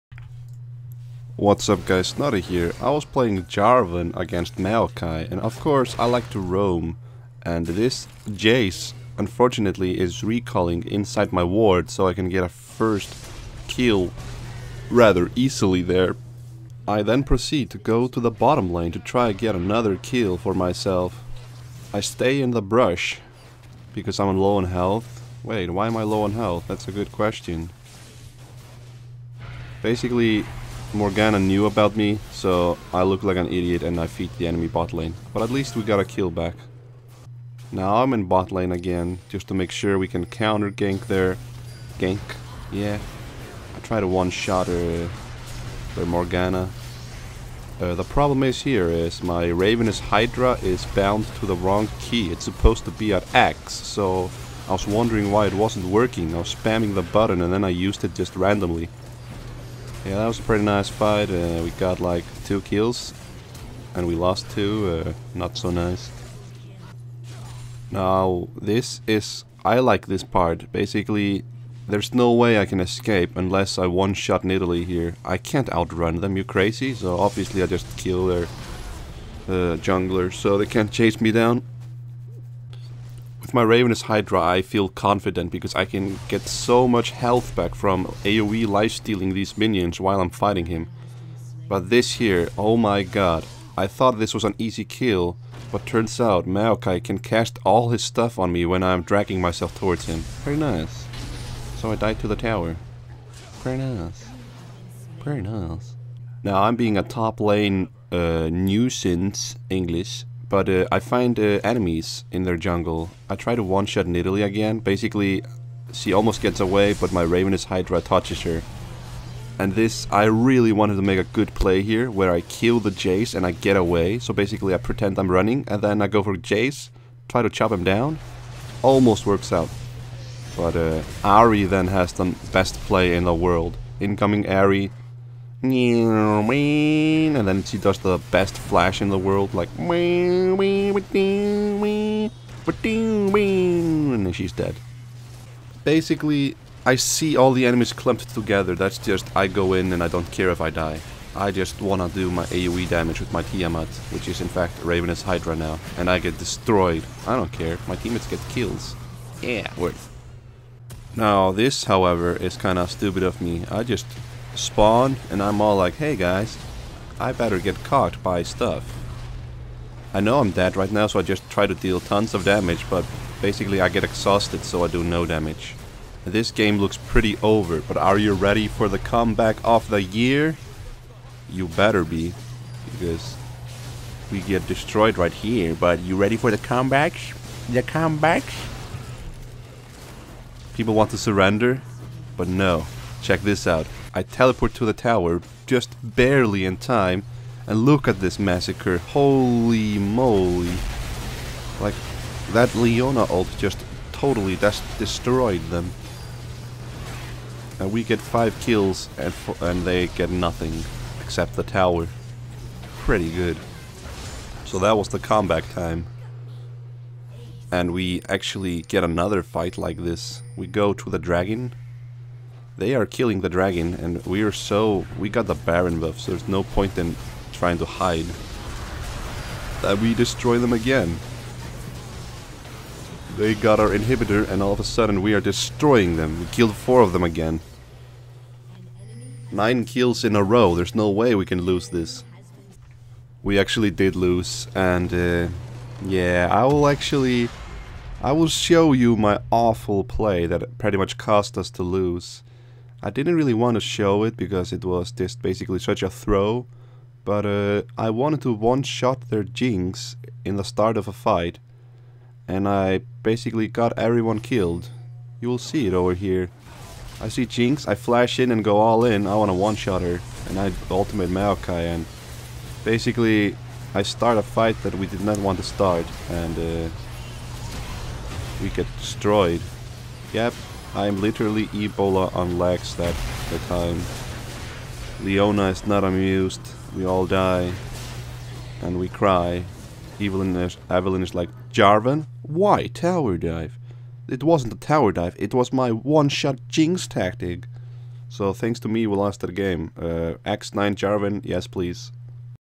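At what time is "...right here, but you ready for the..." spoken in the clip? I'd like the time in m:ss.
3:05.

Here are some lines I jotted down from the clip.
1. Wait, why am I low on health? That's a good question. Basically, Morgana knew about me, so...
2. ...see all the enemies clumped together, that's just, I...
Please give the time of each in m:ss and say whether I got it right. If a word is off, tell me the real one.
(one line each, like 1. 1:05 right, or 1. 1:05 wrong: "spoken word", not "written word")
1. 0:25 right
2. 2:26 right.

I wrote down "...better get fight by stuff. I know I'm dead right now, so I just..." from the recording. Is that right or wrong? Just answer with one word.
wrong.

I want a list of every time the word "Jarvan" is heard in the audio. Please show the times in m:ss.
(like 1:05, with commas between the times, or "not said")
0:03, 4:51, 5:00.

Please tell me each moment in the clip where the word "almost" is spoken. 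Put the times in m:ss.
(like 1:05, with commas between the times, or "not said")
1:56, 2:08.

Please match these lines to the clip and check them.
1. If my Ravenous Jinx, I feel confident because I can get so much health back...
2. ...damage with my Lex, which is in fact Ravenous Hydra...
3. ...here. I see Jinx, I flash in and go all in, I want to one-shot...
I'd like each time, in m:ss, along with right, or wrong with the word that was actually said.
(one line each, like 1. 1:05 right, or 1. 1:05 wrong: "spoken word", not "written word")
1. 1:23 wrong: "Hydra", not "Jinx"
2. 2:32 wrong: "Tiamat", not "Lex"
3. 4:26 right.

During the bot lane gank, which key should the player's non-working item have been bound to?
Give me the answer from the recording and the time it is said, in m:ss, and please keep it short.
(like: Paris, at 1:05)
X, at 0:53.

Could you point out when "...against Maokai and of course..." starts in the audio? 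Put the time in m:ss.
0:04.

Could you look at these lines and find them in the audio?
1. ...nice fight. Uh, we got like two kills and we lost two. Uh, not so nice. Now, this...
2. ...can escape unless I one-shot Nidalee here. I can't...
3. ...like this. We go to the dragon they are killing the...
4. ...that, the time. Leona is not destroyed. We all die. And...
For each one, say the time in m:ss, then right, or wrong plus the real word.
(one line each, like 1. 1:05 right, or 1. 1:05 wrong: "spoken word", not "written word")
1. 1:00 right
2. 1:12 right
3. 3:39 right
4. 4:42 wrong: "amused", not "destroyed".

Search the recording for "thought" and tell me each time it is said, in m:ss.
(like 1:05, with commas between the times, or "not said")
1:33.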